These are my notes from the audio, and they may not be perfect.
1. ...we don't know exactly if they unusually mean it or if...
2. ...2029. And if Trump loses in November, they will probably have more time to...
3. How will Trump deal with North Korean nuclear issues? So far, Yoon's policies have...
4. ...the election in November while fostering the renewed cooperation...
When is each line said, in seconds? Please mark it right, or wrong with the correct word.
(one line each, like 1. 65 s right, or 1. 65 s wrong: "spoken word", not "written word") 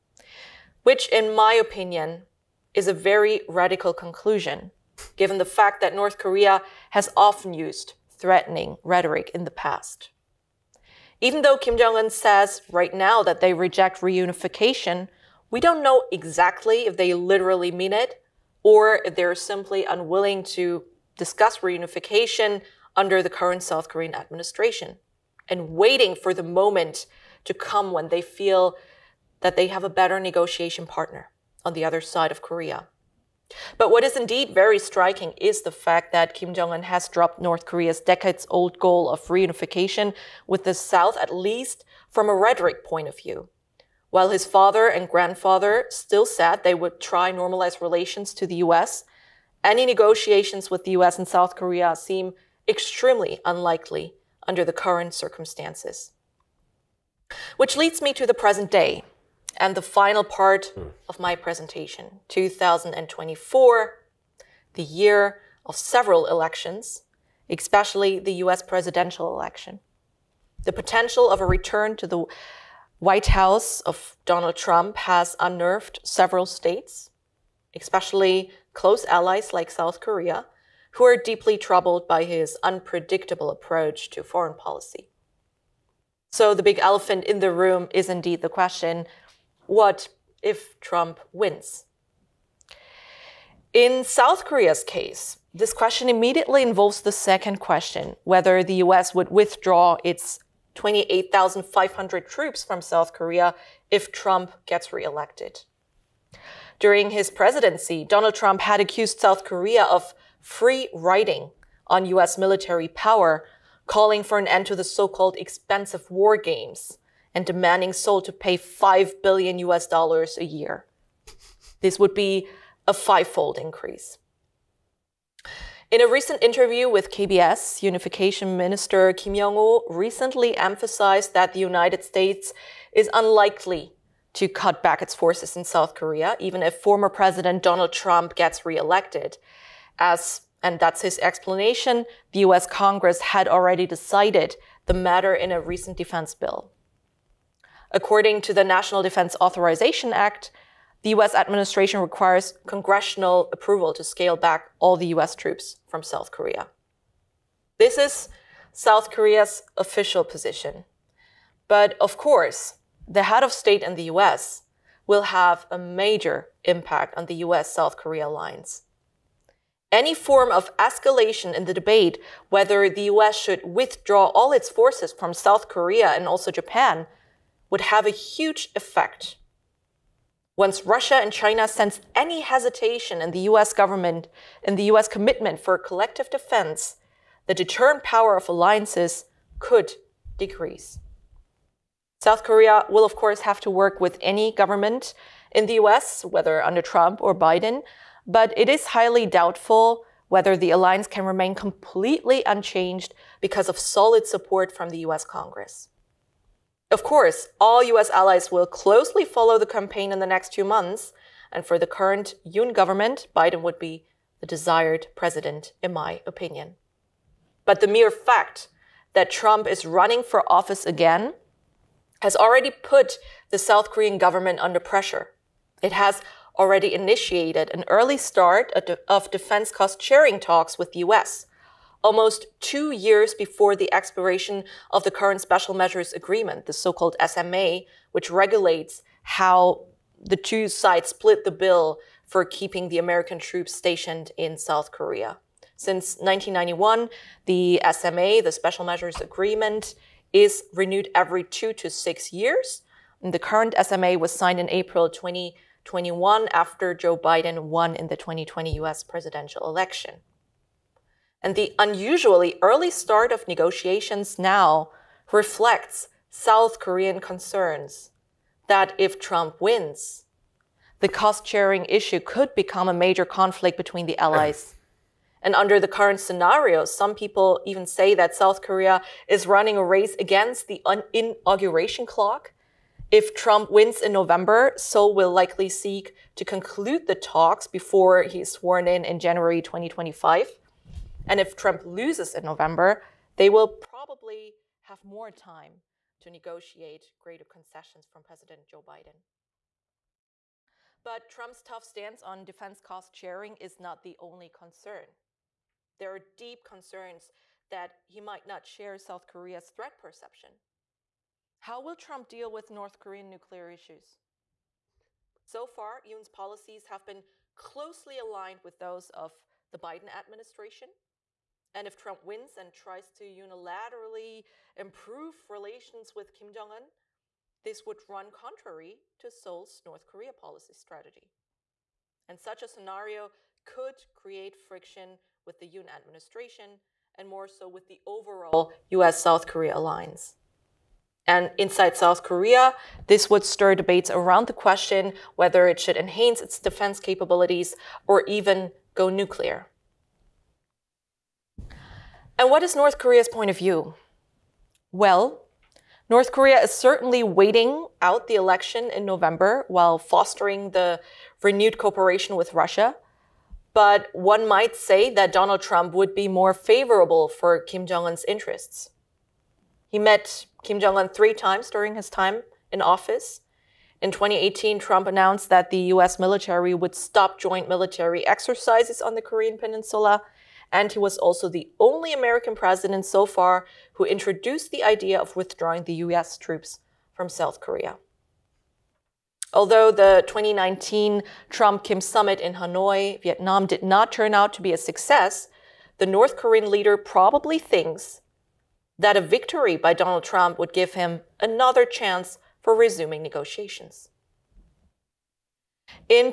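1. 15 s wrong: "literally", not "unusually"
2. 289 s wrong: "2025", not "2029"
3. 311 s right
4. 358 s right.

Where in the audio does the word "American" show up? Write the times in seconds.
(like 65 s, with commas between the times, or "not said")
242 s, 382 s.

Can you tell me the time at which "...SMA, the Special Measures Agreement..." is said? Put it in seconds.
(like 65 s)
247 s.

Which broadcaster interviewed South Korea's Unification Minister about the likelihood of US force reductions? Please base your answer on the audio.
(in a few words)
KBS.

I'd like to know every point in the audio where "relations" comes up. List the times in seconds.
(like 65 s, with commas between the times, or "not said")
47 s, 325 s.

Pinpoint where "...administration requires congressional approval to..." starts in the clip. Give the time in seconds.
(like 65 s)
151 s.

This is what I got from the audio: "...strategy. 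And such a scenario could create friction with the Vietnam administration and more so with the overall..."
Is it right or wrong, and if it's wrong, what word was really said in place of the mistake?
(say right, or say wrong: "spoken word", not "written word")
wrong: "Yoon", not "Vietnam".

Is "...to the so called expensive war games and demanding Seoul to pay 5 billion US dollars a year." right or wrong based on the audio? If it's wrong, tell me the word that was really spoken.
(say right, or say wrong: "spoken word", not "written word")
right.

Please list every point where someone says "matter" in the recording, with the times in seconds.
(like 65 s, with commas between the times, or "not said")
144 s.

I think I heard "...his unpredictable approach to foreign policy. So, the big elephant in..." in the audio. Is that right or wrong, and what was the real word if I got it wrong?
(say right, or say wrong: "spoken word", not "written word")
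right.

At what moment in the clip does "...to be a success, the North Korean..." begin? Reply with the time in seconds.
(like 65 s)
394 s.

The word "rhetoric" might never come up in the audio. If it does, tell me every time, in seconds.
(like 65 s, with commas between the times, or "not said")
8 s, 42 s.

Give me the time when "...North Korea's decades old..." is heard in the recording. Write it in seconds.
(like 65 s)
37 s.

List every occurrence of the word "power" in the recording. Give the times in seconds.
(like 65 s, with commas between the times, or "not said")
112 s, 188 s.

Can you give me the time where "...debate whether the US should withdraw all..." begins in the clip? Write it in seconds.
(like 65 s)
171 s.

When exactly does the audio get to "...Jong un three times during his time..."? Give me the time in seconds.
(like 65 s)
370 s.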